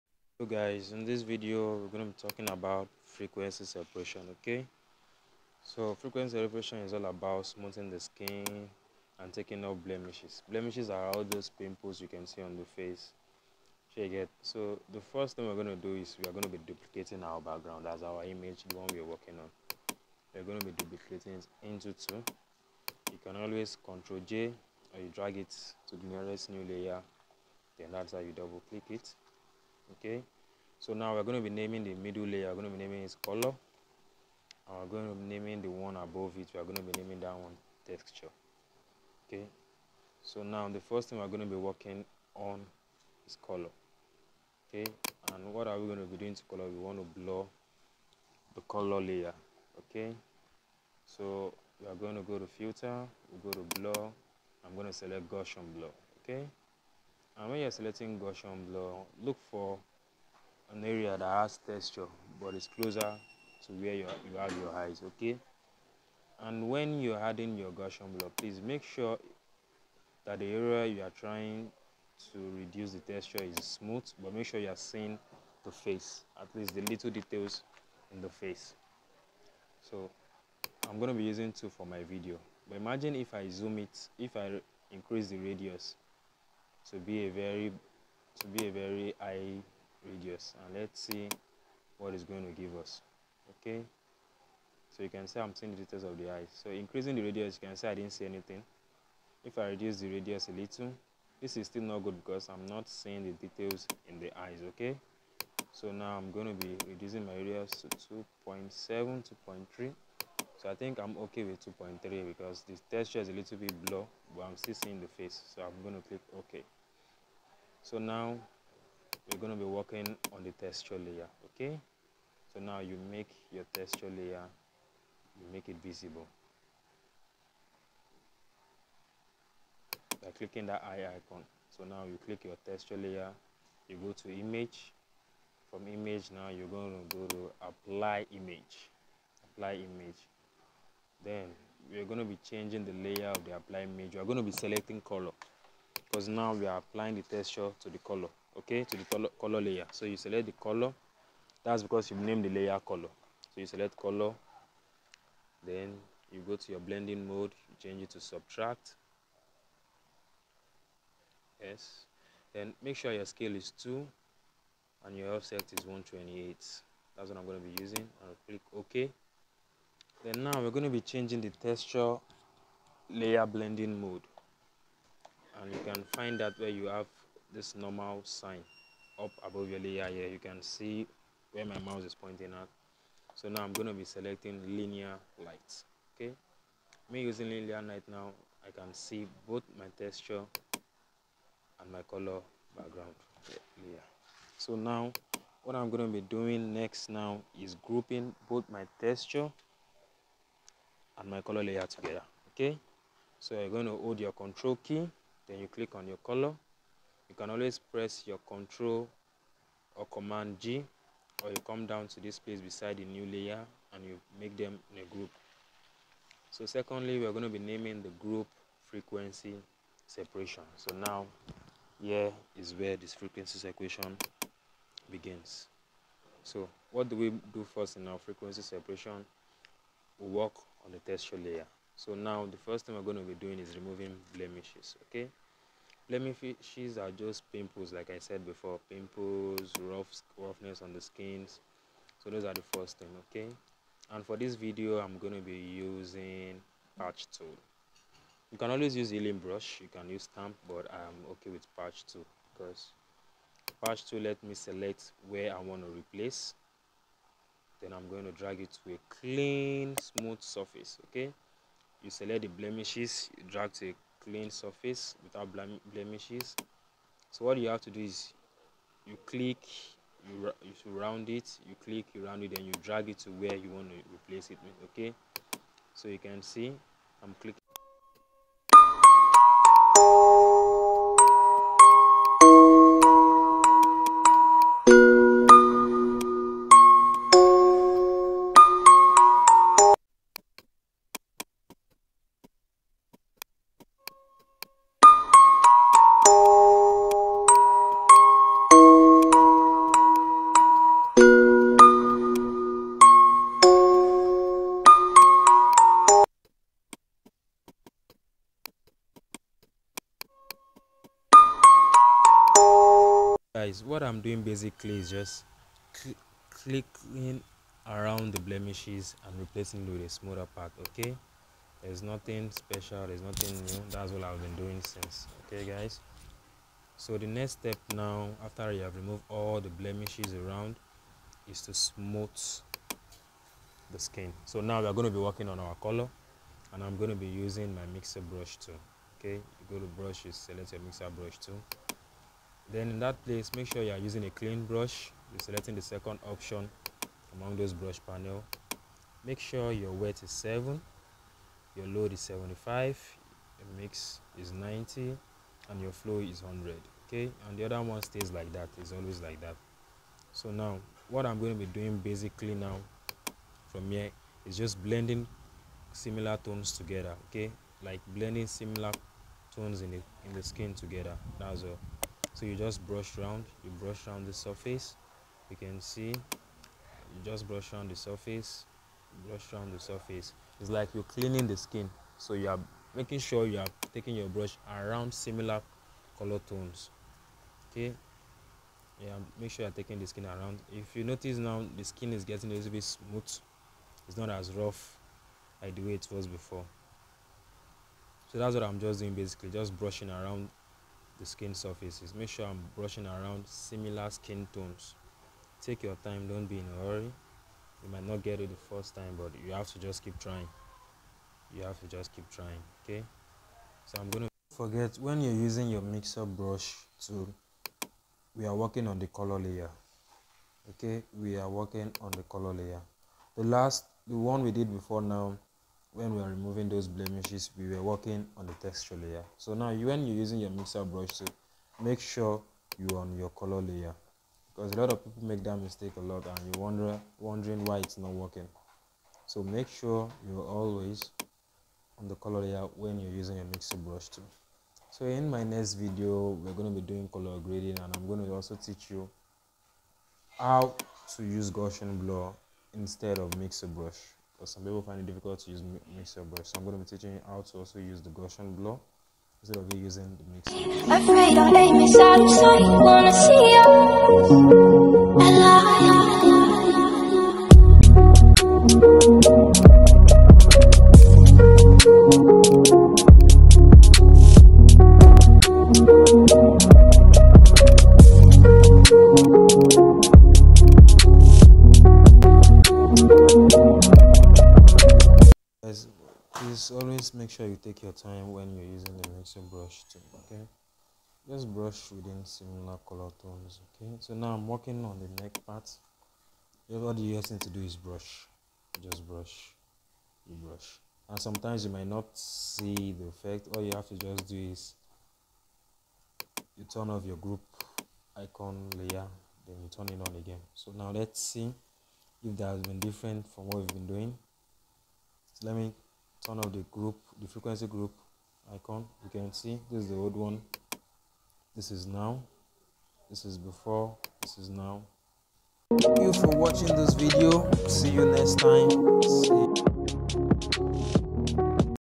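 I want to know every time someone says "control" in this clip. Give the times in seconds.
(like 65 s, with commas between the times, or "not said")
23 s, 204 s, 208 s.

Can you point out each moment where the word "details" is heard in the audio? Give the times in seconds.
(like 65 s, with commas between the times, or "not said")
77 s, 95 s, 103 s.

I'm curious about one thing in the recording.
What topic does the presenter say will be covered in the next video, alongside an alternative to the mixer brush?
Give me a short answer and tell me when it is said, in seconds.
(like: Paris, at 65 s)
color grading, at 447 s.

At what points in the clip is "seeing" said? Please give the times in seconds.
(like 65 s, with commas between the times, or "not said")
74 s, 95 s, 102 s, 114 s.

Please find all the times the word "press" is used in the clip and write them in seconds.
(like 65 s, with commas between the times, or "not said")
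207 s.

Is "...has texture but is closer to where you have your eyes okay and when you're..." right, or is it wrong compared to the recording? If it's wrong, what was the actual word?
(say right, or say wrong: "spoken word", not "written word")
right.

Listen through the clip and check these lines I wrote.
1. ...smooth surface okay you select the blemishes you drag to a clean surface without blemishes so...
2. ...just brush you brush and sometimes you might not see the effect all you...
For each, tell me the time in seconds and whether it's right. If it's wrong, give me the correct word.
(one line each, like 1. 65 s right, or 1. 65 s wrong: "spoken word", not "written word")
1. 259 s right
2. 498 s right.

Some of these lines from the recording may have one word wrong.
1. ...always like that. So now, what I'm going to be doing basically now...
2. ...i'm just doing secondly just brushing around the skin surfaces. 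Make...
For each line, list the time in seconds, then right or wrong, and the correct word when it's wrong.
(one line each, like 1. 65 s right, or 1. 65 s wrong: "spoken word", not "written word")
1. 358 s right
2. 398 s wrong: "basically", not "secondly".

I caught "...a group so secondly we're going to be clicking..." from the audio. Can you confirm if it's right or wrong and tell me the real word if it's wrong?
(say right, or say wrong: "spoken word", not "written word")
wrong: "naming", not "clicking".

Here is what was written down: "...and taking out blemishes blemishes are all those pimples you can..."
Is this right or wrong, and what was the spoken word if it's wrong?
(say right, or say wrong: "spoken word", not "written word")
right.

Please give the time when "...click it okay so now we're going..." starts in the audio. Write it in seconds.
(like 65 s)
28 s.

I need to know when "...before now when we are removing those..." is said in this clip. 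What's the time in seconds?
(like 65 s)
424 s.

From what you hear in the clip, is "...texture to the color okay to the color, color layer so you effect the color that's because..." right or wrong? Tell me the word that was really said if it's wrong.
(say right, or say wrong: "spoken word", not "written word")
wrong: "select", not "effect".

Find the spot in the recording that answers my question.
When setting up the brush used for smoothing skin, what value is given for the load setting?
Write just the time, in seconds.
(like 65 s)
352 s.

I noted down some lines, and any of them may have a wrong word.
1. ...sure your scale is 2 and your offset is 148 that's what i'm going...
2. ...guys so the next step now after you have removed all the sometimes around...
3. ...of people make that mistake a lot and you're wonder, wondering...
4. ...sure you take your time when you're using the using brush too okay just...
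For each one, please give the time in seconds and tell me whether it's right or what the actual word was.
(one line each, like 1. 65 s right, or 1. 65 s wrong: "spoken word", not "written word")
1. 162 s wrong: "128", not "148"
2. 325 s wrong: "blemishes", not "sometimes"
3. 434 s right
4. 487 s wrong: "mixing", not "using".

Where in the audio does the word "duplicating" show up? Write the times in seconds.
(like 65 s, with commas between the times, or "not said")
16 s, 20 s.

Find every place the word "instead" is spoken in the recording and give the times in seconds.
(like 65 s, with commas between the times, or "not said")
452 s, 459 s.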